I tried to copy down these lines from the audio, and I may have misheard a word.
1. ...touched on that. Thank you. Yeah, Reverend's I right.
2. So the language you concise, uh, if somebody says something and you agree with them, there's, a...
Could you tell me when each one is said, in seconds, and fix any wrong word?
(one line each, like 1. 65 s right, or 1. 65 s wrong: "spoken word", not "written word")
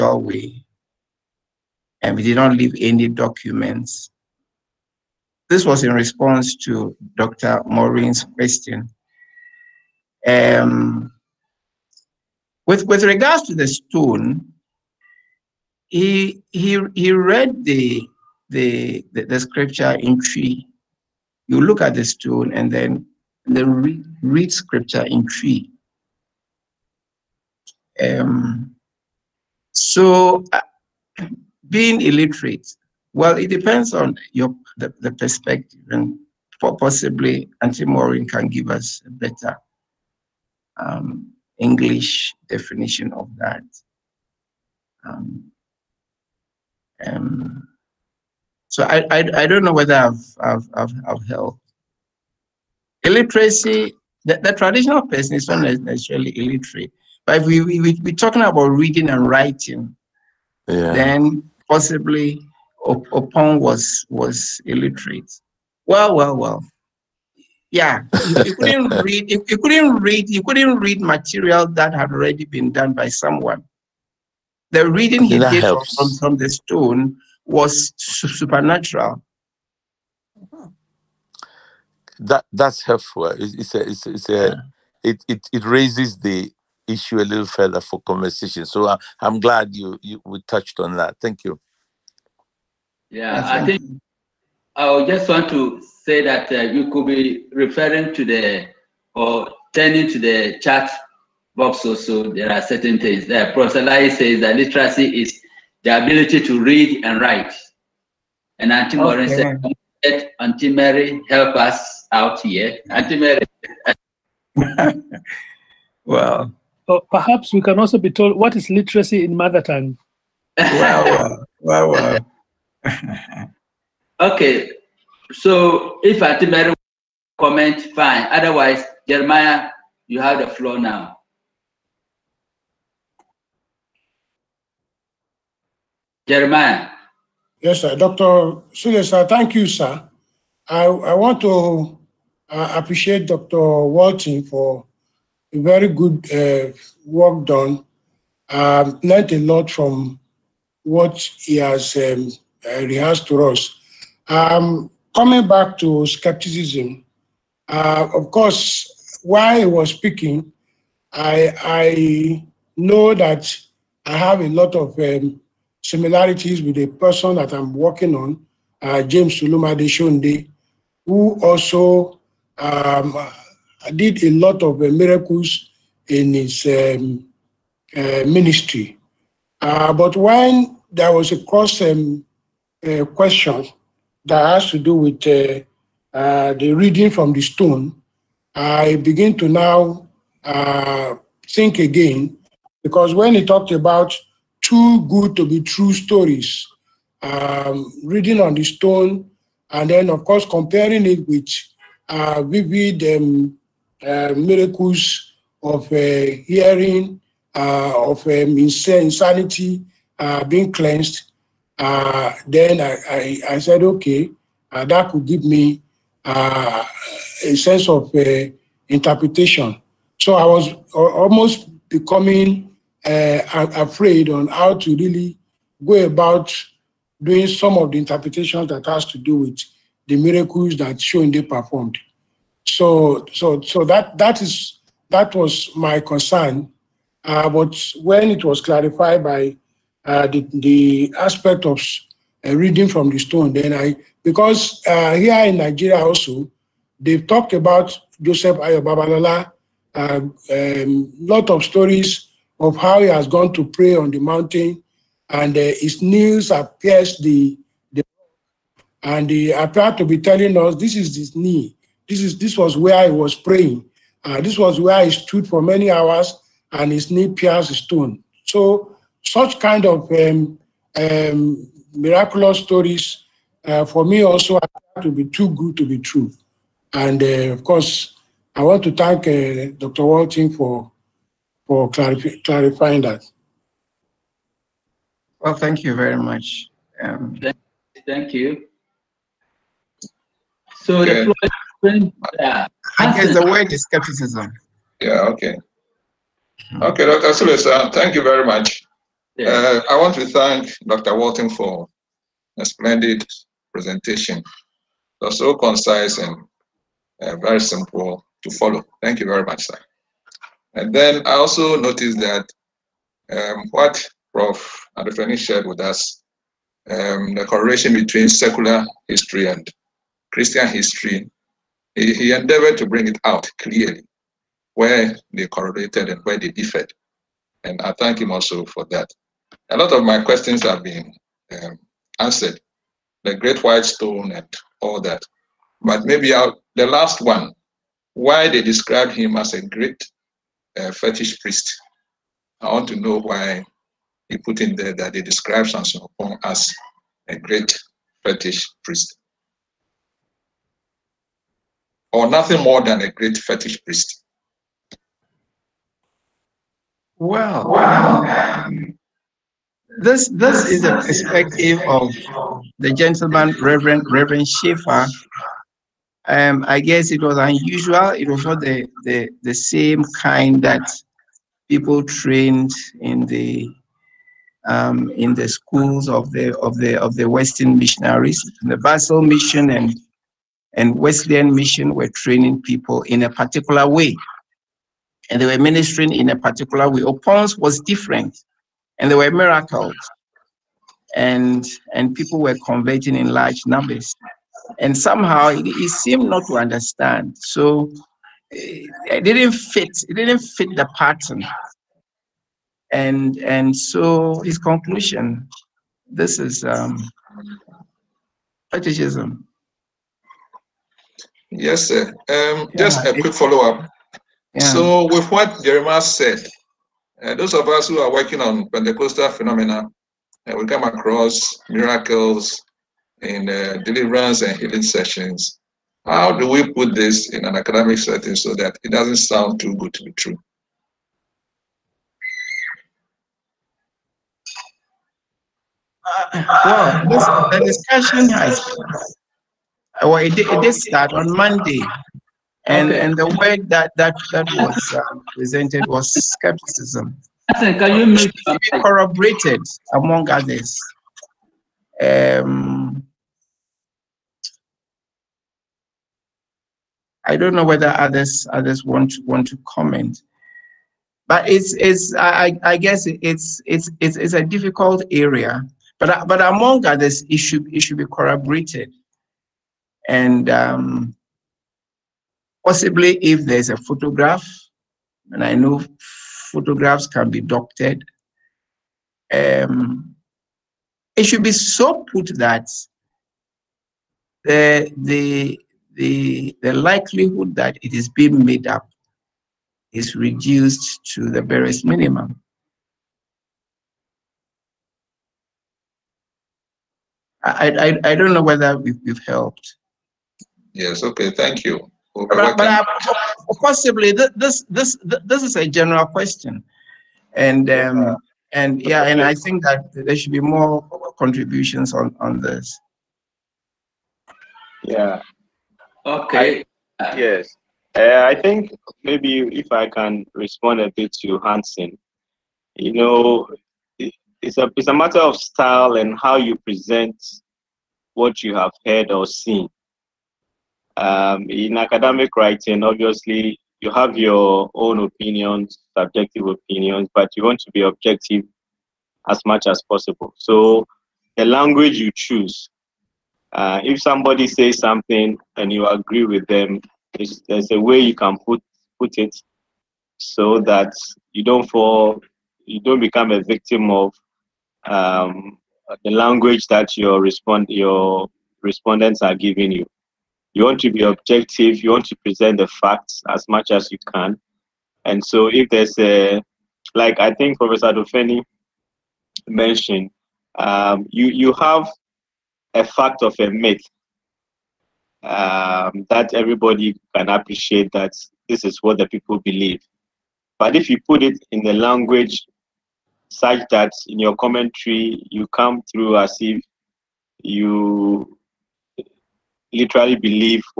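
1. 90 s wrong: "That", not "Reverend"
2. 540 s wrong: "choose", not "concise".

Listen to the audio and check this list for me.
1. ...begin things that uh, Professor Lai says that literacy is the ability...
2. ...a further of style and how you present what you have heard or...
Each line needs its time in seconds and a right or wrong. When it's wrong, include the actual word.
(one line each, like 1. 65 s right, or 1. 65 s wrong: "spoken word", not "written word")
1. 102 s wrong: "certain", not "begin"
2. 524 s wrong: "matter", not "further".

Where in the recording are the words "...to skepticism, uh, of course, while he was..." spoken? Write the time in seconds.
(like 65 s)
155 s.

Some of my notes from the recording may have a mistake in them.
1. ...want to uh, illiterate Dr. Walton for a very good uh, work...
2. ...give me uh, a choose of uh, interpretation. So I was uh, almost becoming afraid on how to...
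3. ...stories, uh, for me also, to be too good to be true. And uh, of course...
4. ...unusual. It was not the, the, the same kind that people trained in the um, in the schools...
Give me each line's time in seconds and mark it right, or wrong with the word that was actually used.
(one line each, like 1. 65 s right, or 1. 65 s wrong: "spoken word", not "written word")
1. 141 s wrong: "appreciate", not "illiterate"
2. 215 s wrong: "sense", not "choose"
3. 272 s right
4. 367 s right.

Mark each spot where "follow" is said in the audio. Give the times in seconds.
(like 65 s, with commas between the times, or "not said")
308 s, 413 s.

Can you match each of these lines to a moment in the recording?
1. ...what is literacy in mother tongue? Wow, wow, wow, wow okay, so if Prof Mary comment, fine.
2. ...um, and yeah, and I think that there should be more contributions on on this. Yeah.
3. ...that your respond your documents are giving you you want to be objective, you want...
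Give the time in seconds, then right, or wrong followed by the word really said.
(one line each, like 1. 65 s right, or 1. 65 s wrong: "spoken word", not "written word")
1. 118 s wrong: "Auntie", not "Prof"
2. 507 s right
3. 556 s wrong: "respondents", not "documents".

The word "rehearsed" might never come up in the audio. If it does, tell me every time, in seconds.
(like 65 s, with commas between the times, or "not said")
152 s.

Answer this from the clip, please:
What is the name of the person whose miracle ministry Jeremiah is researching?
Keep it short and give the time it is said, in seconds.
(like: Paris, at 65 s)
James Suluma Deshonde, at 169 s.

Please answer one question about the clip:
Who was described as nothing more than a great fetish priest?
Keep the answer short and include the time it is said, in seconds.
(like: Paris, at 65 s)
Samson Oppong, at 345 s.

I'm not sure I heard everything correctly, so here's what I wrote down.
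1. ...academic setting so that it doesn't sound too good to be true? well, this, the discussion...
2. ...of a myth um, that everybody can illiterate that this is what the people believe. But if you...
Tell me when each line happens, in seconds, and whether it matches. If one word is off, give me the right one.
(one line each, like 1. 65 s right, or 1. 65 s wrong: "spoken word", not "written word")
1. 427 s right
2. 573 s wrong: "appreciate", not "illiterate".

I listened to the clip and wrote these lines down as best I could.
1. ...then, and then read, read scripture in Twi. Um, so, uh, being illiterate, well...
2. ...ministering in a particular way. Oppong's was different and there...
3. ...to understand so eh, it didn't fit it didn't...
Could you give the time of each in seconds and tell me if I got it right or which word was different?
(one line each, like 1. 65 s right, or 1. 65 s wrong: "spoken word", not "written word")
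1. 22 s right
2. 385 s right
3. 396 s right.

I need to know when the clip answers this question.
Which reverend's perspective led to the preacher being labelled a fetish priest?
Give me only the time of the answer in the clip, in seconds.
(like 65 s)
364 s.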